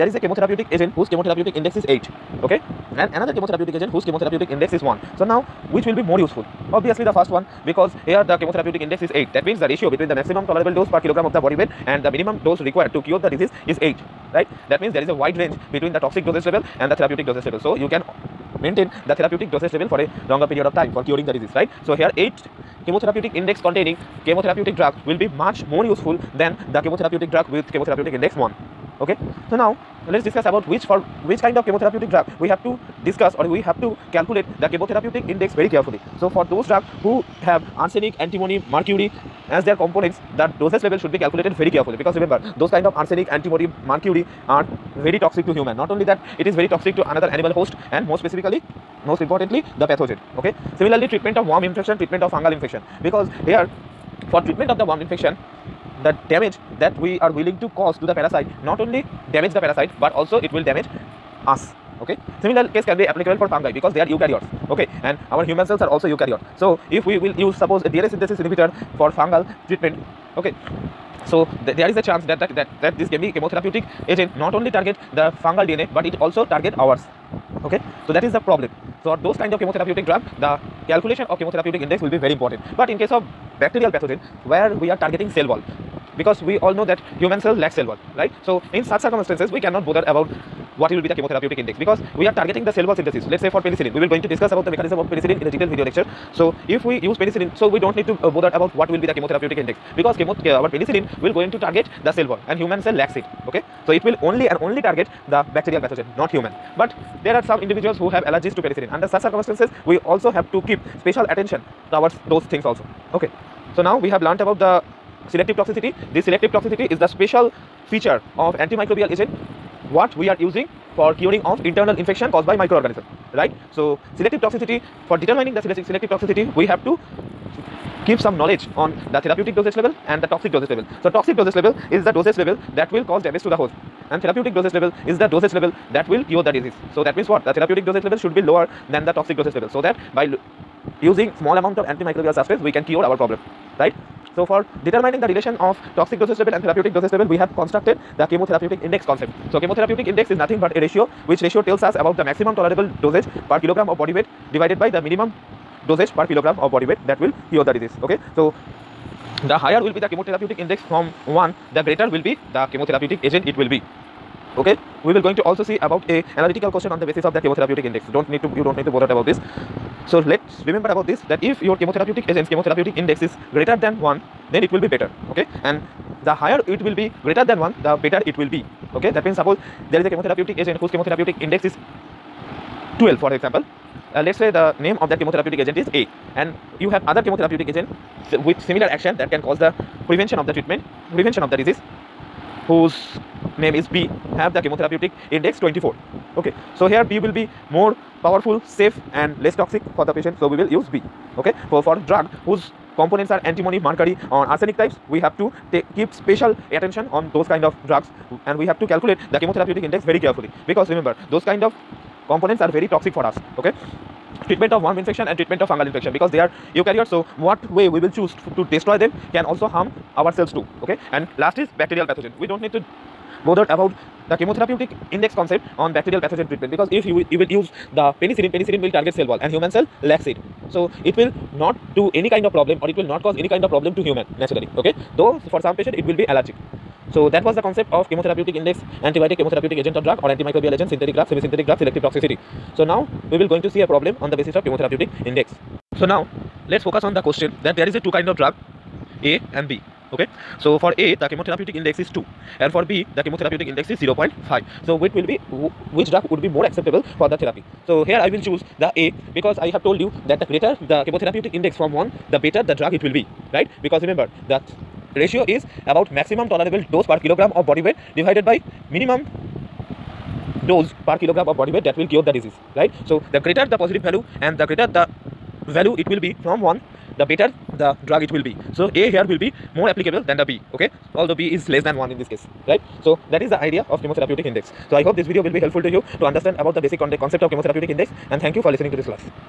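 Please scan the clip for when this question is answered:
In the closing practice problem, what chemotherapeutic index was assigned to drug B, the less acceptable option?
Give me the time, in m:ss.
4:13.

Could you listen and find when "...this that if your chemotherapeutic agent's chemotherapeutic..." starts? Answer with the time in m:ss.
2:51.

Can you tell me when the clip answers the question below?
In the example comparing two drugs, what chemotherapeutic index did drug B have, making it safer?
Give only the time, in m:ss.
3:15.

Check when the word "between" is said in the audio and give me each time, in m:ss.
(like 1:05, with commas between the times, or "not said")
0:09, 0:15.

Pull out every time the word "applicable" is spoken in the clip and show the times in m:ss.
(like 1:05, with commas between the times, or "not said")
1:03, 4:39.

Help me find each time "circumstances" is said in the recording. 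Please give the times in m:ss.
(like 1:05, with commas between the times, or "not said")
1:29, 1:49.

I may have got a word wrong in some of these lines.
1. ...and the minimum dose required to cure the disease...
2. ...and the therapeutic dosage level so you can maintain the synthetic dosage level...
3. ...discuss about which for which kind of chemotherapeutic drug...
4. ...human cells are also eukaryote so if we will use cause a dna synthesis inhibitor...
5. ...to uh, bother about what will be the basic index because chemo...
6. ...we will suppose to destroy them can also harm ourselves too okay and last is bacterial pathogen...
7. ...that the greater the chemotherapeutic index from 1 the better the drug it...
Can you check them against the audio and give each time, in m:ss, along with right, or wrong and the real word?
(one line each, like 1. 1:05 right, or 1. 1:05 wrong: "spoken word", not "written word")
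1. 0:11 right
2. 0:16 wrong: "therapeutic", not "synthetic"
3. 0:30 right
4. 1:05 wrong: "suppose", not "cause"
5. 1:38 wrong: "chemotherapeutic", not "basic"
6. 3:37 wrong: "choose", not "suppose"
7. 4:20 right.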